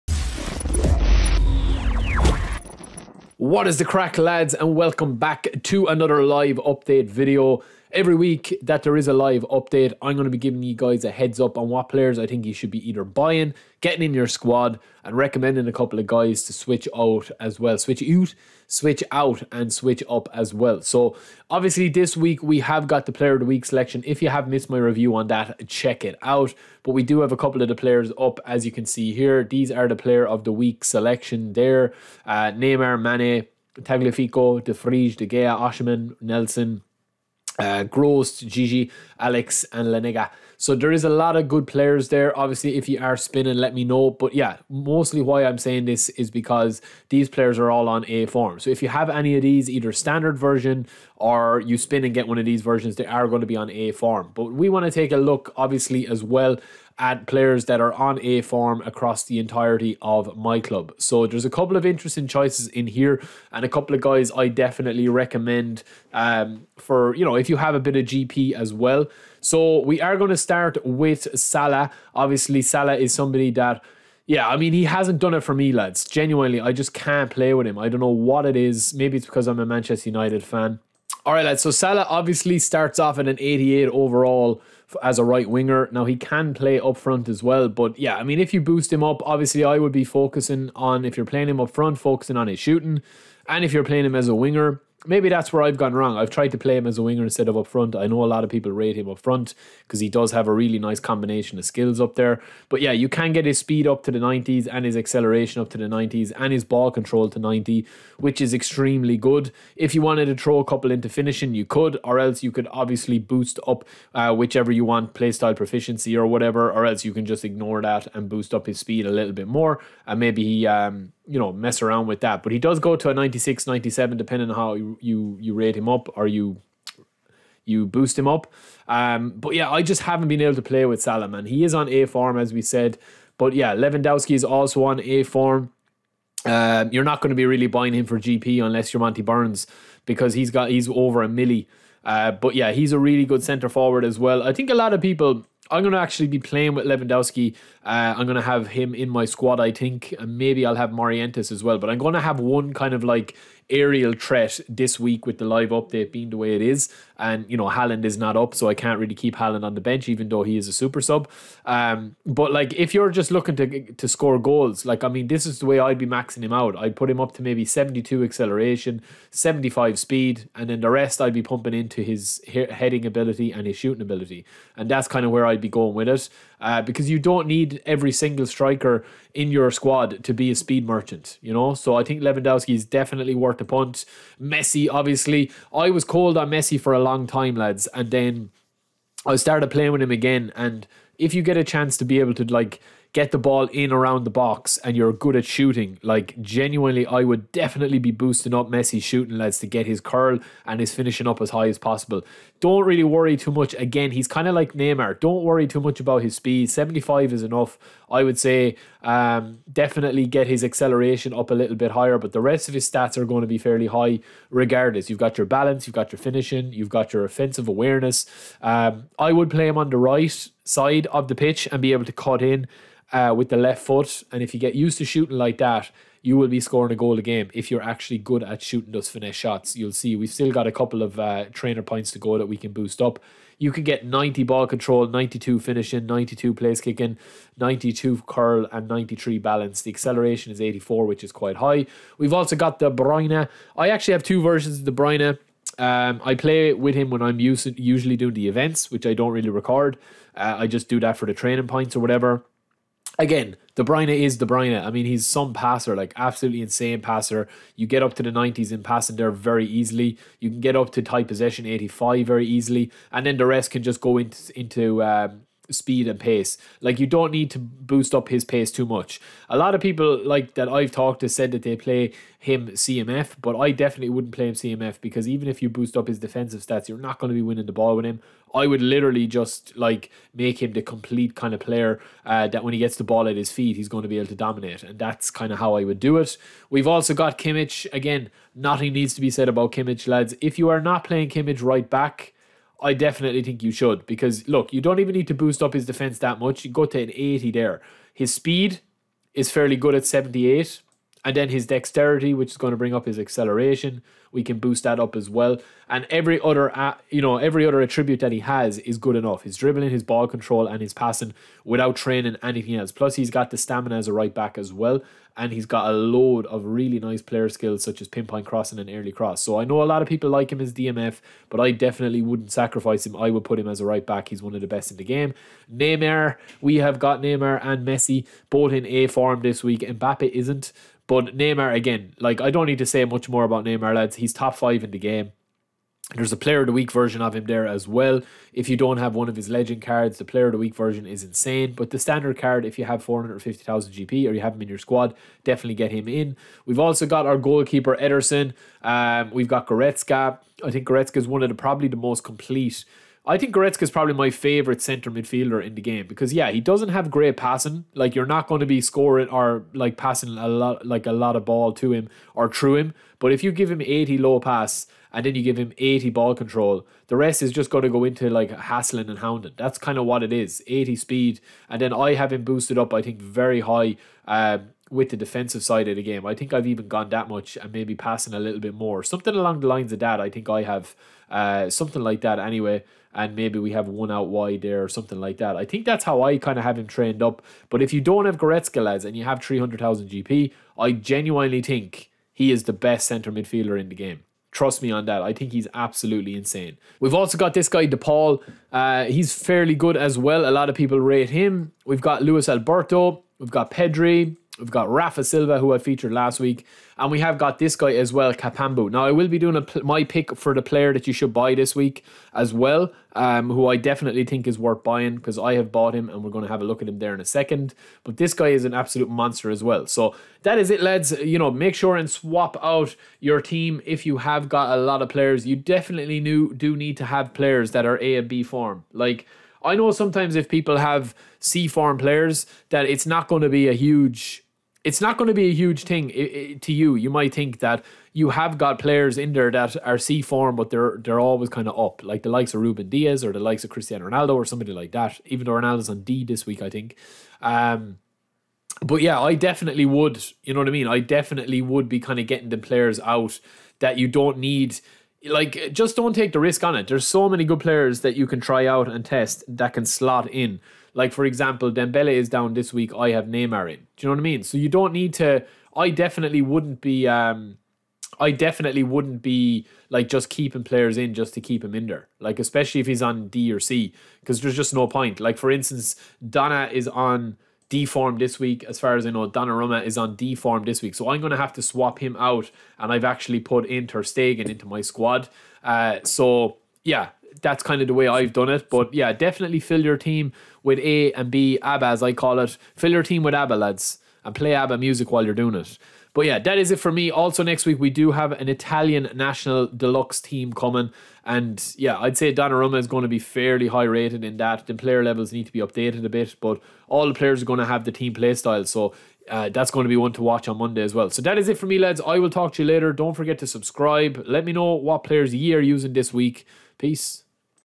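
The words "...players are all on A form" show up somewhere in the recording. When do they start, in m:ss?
0:47.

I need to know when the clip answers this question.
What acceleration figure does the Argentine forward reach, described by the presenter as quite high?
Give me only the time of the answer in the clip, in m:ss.
3:59.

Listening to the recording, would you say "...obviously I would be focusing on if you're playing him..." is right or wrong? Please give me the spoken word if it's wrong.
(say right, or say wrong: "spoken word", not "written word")
right.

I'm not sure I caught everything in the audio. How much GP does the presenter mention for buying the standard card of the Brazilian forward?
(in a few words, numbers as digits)
450,000 GP.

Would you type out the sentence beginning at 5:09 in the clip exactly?
His dribbling, his ball control, and his passing without training anything else.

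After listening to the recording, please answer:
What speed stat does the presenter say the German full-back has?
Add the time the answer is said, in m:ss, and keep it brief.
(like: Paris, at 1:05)
78, at 5:00.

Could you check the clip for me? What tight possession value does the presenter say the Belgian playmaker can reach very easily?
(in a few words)
85.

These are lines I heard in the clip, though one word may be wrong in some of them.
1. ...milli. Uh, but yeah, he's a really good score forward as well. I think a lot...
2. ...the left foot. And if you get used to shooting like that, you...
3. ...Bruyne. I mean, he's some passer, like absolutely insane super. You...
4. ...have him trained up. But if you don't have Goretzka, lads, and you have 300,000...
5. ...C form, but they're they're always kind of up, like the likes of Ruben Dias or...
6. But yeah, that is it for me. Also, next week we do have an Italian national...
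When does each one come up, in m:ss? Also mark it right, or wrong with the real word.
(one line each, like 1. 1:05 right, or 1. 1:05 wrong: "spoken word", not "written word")
1. 2:21 wrong: "centre", not "score"
2. 3:43 right
3. 4:14 wrong: "passer", not "super"
4. 6:26 right
5. 7:19 right
6. 8:16 right.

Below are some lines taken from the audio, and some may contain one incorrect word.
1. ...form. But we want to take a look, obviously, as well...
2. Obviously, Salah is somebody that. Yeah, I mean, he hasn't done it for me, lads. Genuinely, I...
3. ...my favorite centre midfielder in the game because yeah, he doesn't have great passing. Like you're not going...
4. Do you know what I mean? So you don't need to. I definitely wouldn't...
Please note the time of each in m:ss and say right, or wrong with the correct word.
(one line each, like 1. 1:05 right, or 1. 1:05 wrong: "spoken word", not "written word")
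1. 0:53 right
2. 1:12 right
3. 5:54 right
4. 7:43 right.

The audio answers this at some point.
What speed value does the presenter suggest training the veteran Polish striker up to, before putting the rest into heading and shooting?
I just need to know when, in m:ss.
2:49.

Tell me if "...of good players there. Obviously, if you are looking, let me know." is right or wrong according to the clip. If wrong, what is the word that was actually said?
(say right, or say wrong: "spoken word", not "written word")
wrong: "spinning", not "looking".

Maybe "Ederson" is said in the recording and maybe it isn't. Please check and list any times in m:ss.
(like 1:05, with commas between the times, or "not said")
5:47.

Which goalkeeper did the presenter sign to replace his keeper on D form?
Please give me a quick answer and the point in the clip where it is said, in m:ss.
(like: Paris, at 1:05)
Ter Stegen, at 8:03.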